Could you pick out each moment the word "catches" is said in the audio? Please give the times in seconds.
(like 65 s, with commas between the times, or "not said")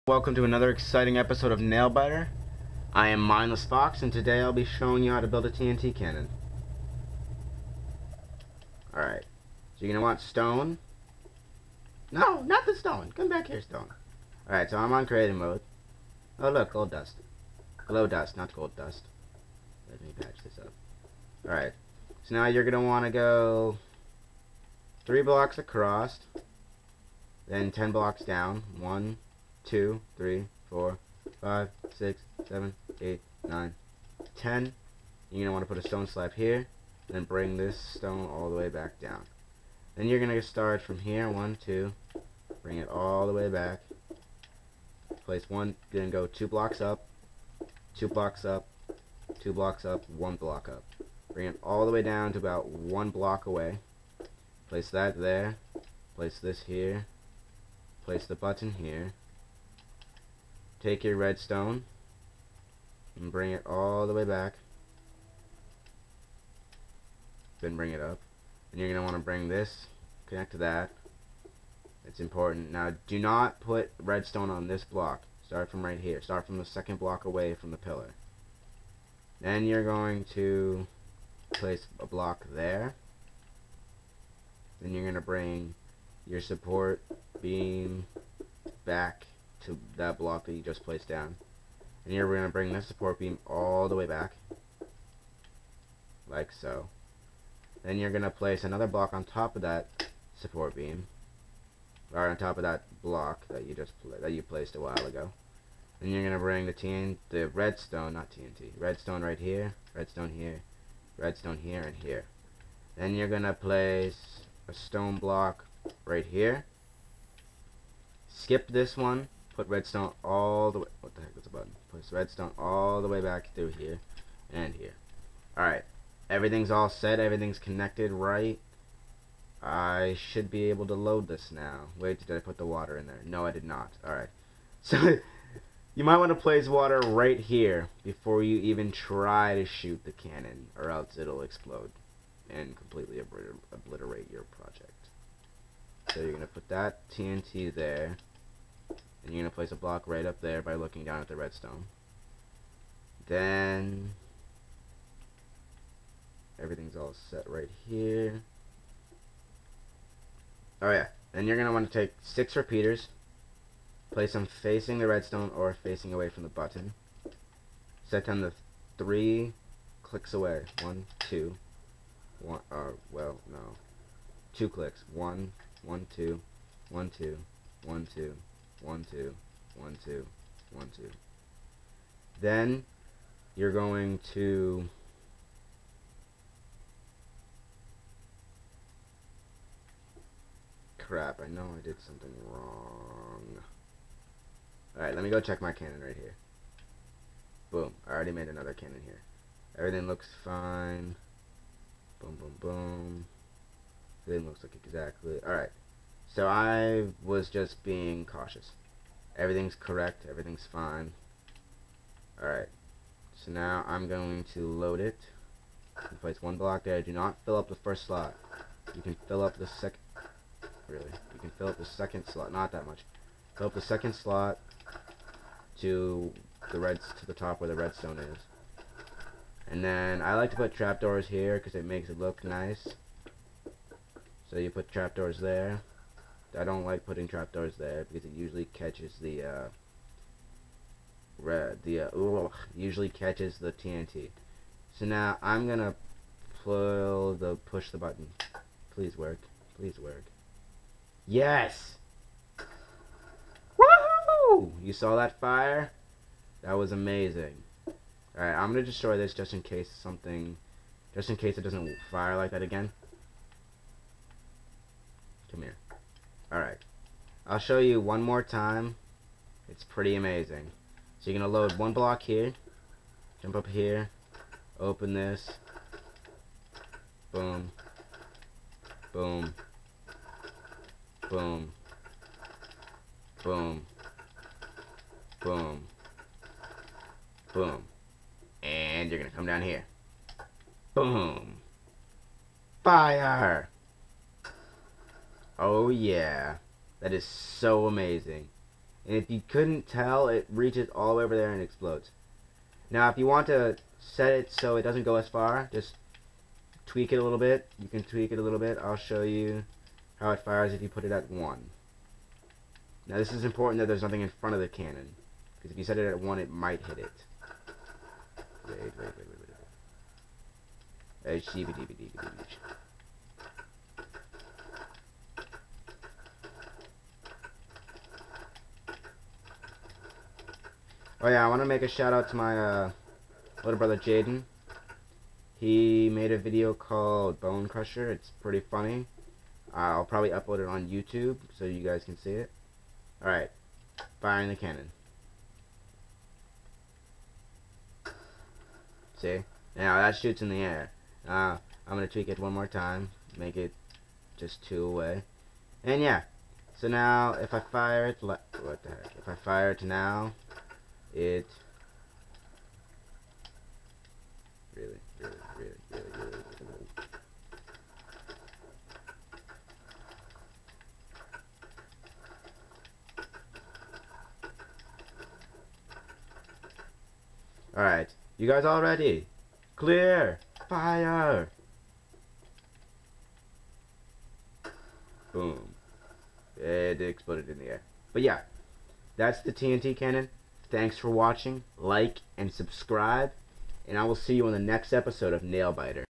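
238 s, 243 s.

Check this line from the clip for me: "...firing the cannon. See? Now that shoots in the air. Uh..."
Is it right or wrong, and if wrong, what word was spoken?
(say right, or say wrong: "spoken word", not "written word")
right.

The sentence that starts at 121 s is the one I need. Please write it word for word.
Place redstone all the way back through here and here.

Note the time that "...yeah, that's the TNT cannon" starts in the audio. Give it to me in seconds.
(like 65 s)
388 s.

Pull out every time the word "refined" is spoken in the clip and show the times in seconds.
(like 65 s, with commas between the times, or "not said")
not said.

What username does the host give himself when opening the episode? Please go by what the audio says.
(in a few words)
Mindless Fox.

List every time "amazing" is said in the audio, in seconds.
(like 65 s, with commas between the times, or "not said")
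256 s, 270 s, 297 s.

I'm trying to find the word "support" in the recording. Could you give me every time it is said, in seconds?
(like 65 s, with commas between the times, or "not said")
86 s, 92 s, 100 s.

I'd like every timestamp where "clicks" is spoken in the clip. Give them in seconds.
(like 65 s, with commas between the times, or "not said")
170 s, 174 s.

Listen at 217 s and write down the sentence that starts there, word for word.
Do not fill up the first slot.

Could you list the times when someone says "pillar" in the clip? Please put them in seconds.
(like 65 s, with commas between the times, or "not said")
77 s.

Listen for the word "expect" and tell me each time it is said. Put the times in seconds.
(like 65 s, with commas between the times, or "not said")
not said.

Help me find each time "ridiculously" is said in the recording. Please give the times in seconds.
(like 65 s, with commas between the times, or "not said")
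not said.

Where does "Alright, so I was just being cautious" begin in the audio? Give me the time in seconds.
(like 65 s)
205 s.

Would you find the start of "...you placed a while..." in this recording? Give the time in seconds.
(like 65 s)
104 s.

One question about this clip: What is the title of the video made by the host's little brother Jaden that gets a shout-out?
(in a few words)
Bone Crusher.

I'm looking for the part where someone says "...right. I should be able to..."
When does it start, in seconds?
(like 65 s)
128 s.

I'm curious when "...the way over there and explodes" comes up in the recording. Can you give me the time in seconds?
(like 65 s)
301 s.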